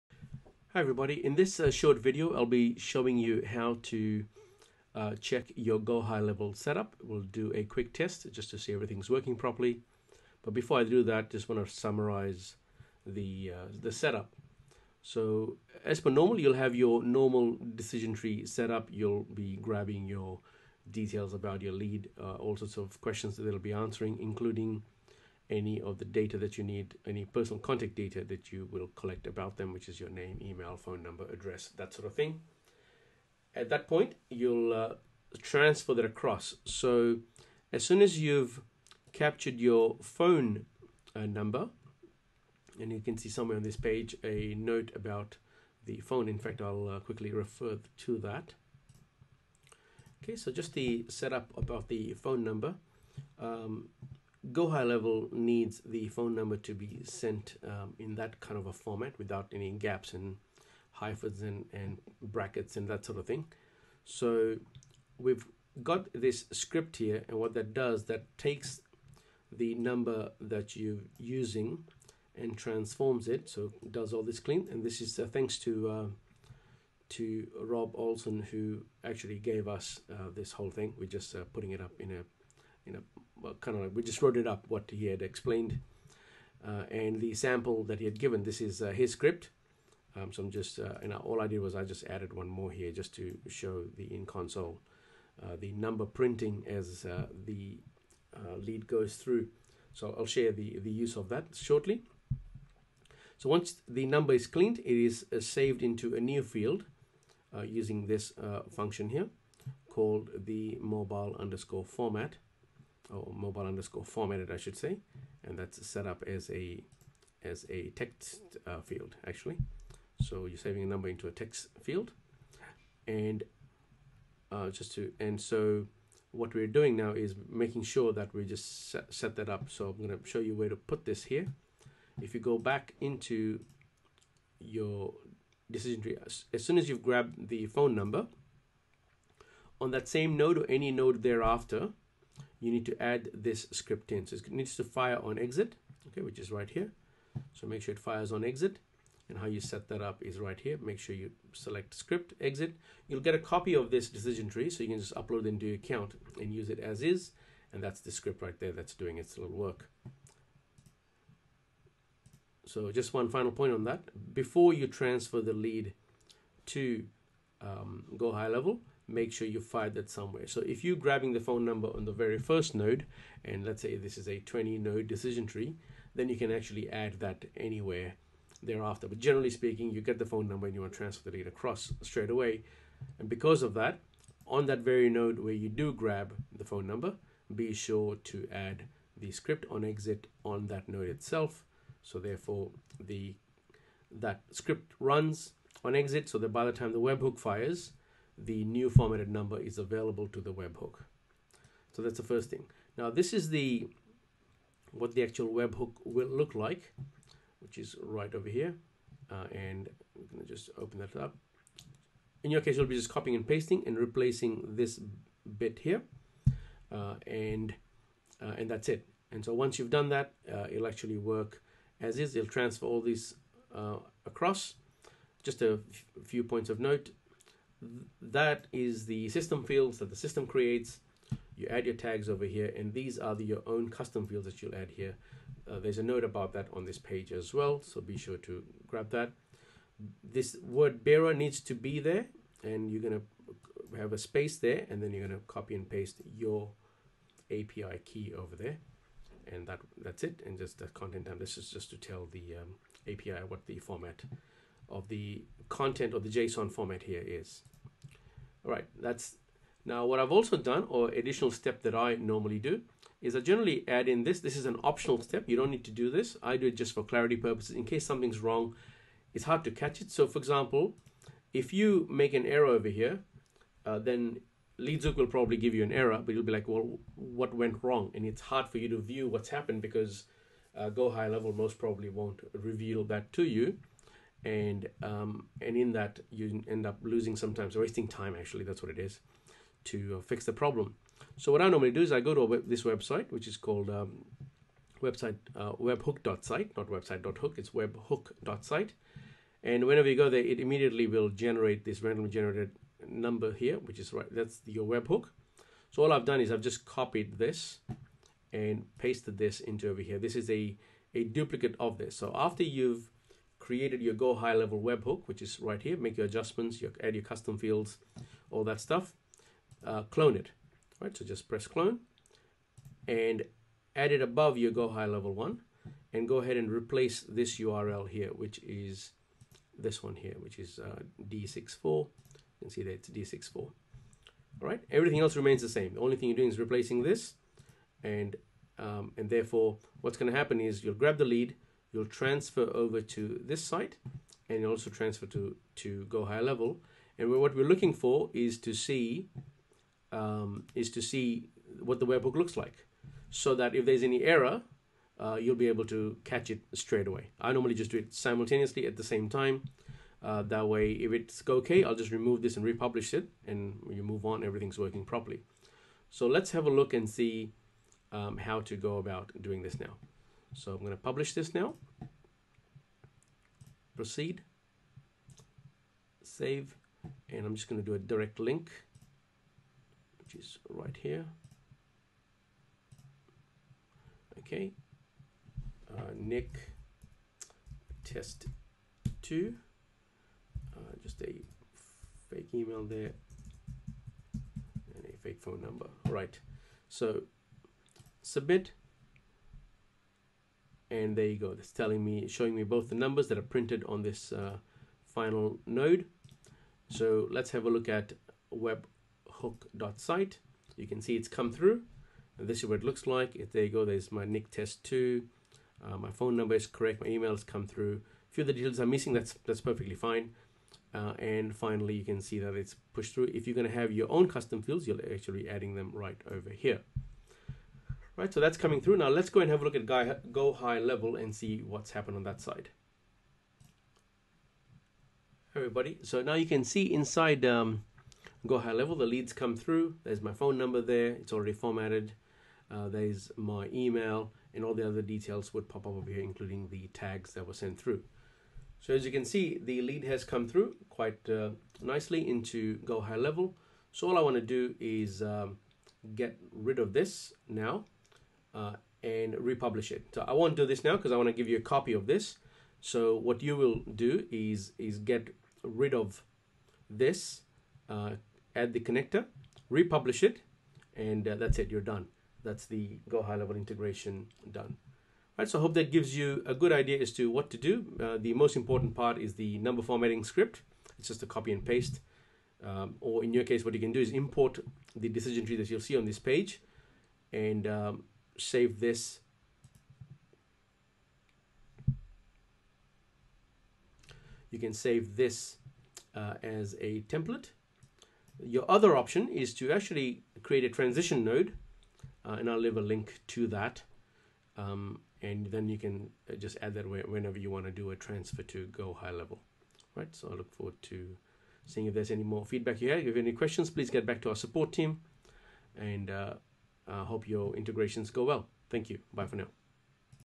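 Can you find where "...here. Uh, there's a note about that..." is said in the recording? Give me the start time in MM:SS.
03:54.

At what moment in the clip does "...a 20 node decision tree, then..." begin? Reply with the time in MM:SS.
02:54.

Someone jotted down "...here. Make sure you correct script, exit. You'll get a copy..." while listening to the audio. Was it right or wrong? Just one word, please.
wrong.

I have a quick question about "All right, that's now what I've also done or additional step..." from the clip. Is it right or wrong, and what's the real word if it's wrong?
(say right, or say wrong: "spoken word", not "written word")
right.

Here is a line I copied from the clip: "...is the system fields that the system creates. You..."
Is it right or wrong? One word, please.
right.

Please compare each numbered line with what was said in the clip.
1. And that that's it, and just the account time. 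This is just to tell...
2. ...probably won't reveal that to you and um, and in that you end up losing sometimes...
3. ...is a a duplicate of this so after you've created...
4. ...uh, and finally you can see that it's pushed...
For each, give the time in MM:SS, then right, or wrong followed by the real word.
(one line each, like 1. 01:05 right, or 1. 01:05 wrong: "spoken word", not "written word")
1. 04:09 wrong: "content", not "account"
2. 04:41 right
3. 05:10 right
4. 07:00 right.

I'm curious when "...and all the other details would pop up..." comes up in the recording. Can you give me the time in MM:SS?
07:24.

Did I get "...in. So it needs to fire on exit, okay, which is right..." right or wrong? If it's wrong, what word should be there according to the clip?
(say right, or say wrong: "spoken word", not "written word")
right.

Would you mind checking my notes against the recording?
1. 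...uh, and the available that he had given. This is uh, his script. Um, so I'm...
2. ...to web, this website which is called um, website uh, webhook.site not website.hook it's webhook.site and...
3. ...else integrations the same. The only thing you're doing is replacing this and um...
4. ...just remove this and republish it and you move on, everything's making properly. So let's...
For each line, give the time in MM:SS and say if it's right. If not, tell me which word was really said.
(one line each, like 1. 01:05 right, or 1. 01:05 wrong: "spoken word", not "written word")
1. 01:26 wrong: "sample", not "available"
2. 04:52 right
3. 05:35 wrong: "remains", not "integrations"
4. 06:01 wrong: "working", not "making".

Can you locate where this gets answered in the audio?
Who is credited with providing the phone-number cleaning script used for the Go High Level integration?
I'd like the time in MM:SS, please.
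01:17.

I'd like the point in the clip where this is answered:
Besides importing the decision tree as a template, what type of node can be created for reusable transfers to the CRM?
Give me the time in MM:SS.
08:20.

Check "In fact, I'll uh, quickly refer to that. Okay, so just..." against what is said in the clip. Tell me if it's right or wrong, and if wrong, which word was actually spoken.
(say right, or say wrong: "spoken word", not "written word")
right.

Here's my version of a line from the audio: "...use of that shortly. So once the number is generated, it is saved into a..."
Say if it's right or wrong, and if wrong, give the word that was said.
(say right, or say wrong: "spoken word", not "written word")
wrong: "cleaned", not "generated".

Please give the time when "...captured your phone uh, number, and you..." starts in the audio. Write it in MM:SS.
00:39.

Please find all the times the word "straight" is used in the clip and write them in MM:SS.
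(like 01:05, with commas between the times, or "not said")
03:02, 05:56.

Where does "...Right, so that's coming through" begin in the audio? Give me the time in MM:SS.
07:08.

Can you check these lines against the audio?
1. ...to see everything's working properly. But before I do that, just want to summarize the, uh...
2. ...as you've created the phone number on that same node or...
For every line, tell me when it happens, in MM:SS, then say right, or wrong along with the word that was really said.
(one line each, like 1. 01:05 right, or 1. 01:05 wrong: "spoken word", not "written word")
1. 00:08 right
2. 02:16 wrong: "grabbed", not "created".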